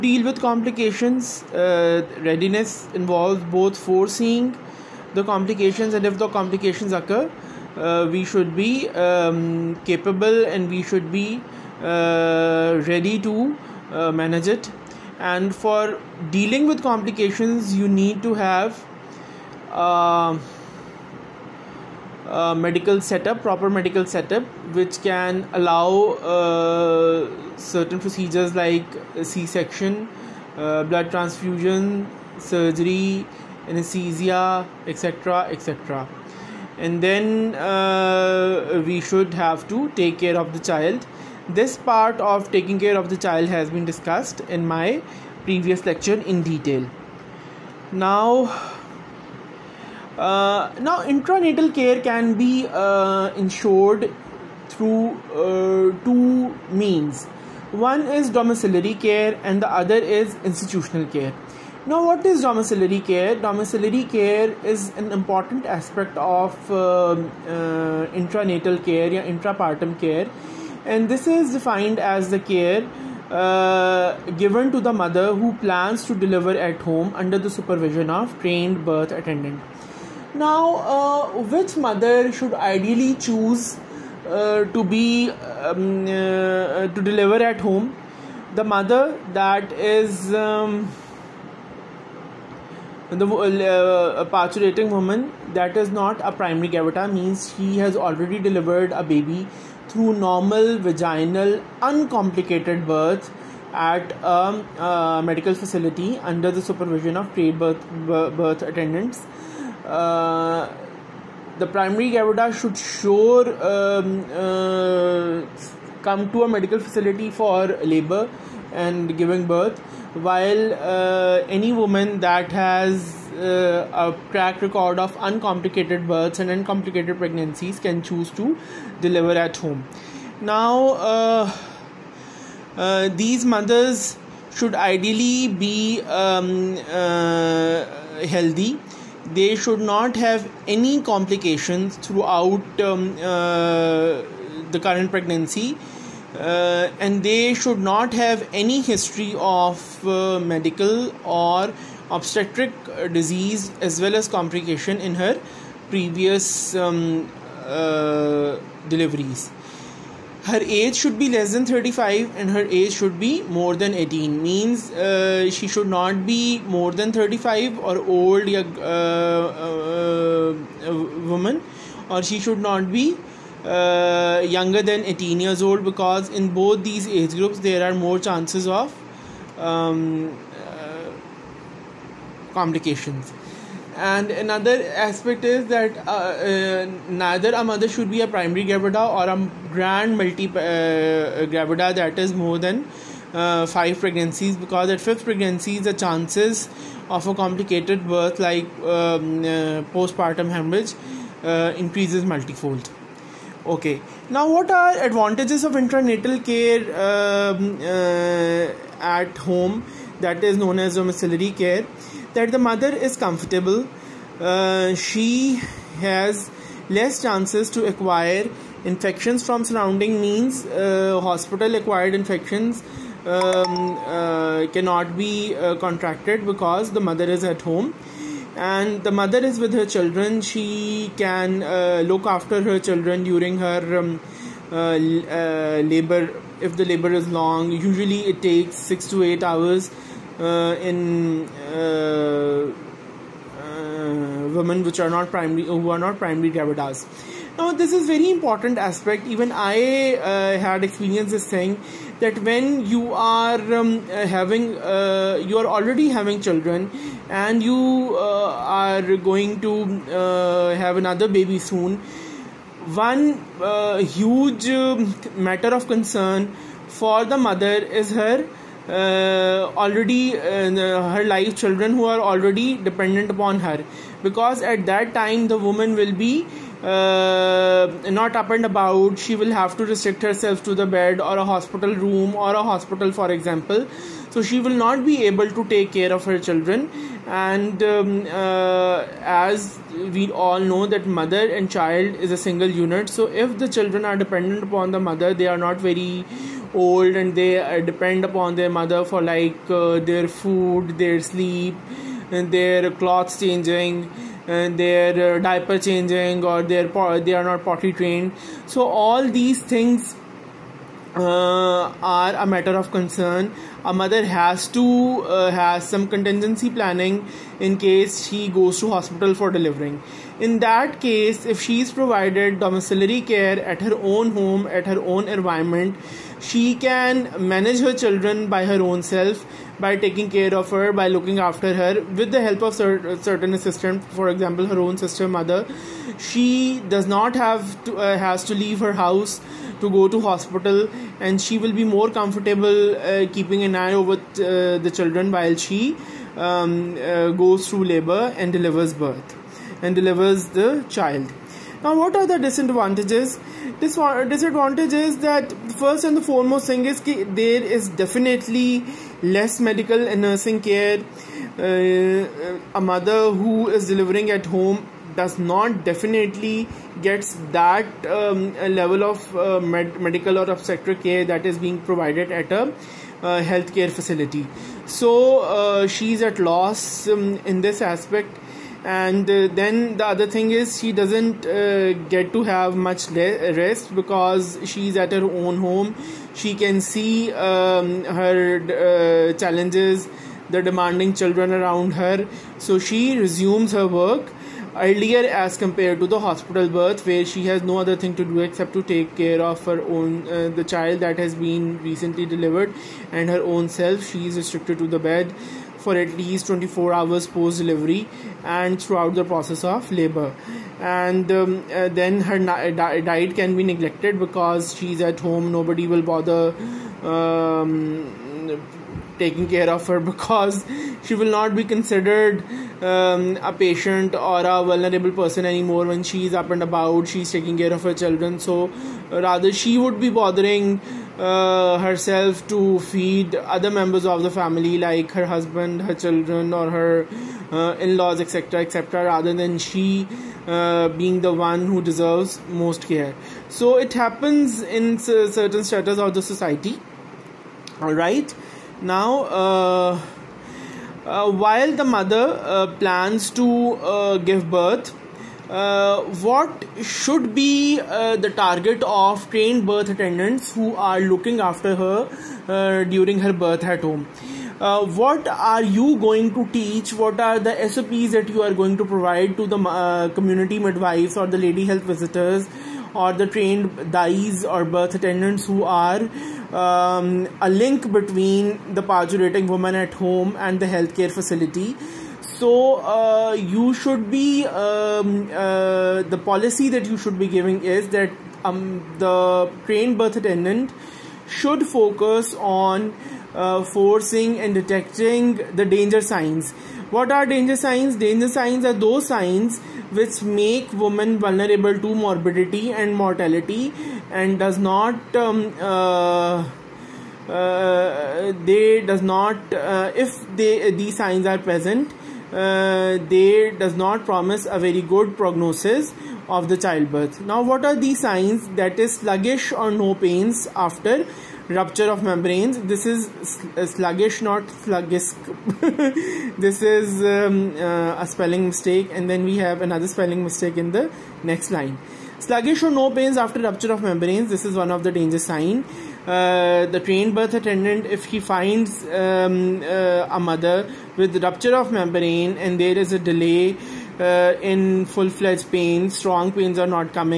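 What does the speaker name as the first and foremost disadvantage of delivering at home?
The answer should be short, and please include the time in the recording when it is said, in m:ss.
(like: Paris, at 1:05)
Less medical and nursing care, at 5:59.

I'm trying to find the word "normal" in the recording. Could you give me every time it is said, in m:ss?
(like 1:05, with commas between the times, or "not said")
1:40.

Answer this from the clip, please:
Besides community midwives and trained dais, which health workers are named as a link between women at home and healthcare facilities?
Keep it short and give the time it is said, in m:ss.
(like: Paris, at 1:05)
Lady health visitors, at 7:51.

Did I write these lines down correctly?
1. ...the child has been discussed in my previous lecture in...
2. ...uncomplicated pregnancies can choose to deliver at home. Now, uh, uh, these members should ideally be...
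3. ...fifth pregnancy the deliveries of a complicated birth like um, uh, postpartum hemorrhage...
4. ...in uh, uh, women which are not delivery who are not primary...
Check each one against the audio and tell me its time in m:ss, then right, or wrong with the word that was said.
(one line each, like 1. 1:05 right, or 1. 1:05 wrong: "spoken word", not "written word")
1. 0:43 right
2. 2:06 wrong: "mothers", not "members"
3. 3:14 wrong: "chances", not "deliveries"
4. 4:00 wrong: "primary", not "delivery".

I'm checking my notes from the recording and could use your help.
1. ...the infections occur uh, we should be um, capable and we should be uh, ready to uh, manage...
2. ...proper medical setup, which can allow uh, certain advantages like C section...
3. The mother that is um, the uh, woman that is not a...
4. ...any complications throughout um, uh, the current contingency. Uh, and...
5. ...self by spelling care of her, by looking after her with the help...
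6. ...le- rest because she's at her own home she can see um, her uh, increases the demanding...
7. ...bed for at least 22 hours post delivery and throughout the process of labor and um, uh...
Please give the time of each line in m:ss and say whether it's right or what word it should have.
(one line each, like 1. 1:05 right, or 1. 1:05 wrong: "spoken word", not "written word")
1. 0:06 wrong: "complications", not "infections"
2. 0:23 wrong: "procedures", not "advantages"
3. 1:28 right
4. 2:20 wrong: "pregnancy", not "contingency"
5. 5:29 wrong: "taking", not "spelling"
6. 6:23 wrong: "challenges", not "increases"
7. 6:44 wrong: "24", not "22".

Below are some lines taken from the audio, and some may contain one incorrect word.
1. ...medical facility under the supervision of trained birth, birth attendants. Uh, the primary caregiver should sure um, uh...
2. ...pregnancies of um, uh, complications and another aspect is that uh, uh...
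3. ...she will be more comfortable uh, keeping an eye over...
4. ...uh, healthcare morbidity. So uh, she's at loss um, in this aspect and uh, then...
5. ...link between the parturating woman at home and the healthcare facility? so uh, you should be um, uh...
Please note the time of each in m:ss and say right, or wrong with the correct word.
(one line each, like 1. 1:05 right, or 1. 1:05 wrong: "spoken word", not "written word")
1. 1:45 right
2. 2:58 wrong: "chances", not "pregnancies"
3. 5:41 right
4. 6:13 wrong: "facility", not "morbidity"
5. 7:57 right.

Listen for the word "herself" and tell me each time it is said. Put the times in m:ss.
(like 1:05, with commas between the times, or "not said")
4:40, 7:11.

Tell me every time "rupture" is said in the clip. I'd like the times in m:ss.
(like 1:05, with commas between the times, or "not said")
8:41, 8:53, 9:01.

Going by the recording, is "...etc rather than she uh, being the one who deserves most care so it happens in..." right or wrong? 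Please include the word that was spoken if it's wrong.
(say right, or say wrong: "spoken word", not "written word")
right.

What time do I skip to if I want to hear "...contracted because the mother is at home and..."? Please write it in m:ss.
3:45.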